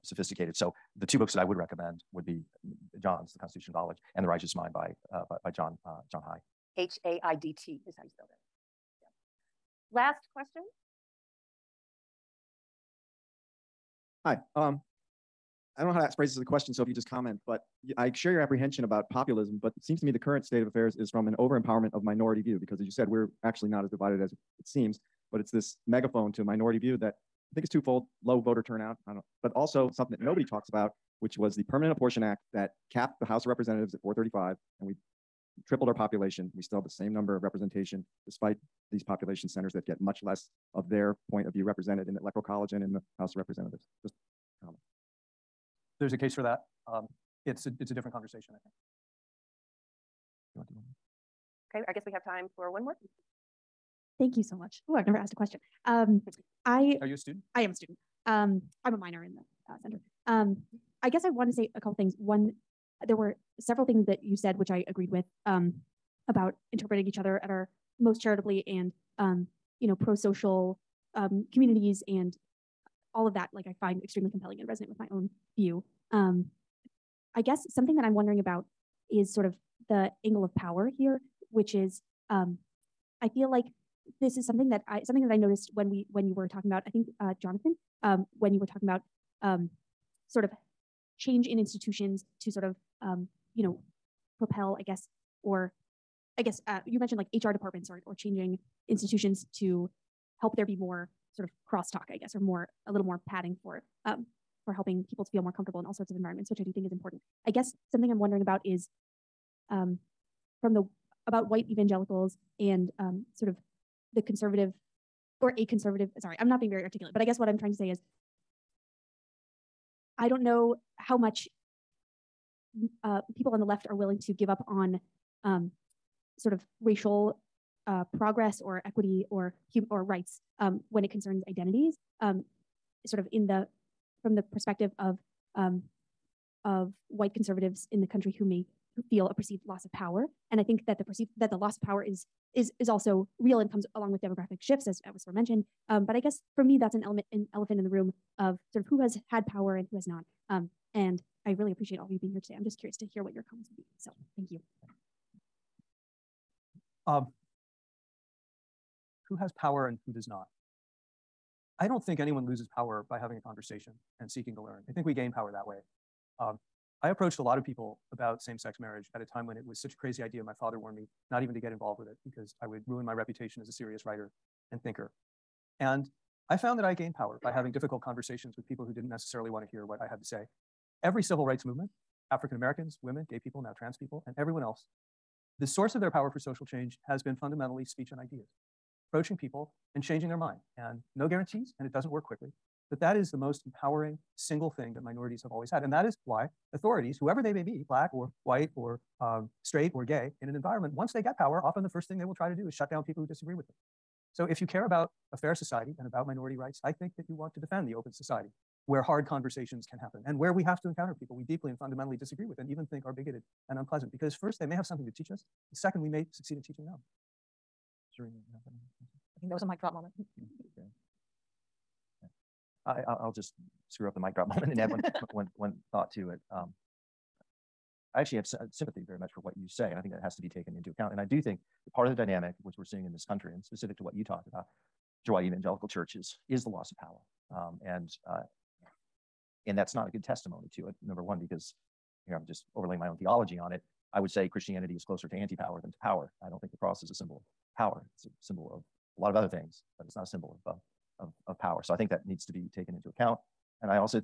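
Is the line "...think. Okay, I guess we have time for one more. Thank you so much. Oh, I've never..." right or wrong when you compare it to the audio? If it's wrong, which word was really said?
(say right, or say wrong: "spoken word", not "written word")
right.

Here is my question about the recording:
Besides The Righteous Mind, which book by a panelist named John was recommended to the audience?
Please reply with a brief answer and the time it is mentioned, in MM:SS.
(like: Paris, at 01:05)
The Constitution of Knowledge, at 00:03.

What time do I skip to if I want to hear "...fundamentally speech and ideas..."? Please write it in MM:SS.
03:07.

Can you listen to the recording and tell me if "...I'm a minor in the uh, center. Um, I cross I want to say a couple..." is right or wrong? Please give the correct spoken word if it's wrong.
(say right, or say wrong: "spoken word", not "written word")
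wrong: "guess", not "cross".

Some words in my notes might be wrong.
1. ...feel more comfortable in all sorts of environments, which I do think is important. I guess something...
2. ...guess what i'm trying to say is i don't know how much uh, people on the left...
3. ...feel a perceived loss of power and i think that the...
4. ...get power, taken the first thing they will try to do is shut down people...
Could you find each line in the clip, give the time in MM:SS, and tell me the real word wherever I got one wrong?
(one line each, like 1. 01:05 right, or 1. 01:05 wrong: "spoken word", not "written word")
1. 01:45 right
2. 01:57 right
3. 02:19 right
4. 03:21 wrong: "often", not "taken".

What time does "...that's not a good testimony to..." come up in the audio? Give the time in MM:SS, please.
03:59.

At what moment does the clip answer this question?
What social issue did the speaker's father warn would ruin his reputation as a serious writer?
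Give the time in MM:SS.
02:48.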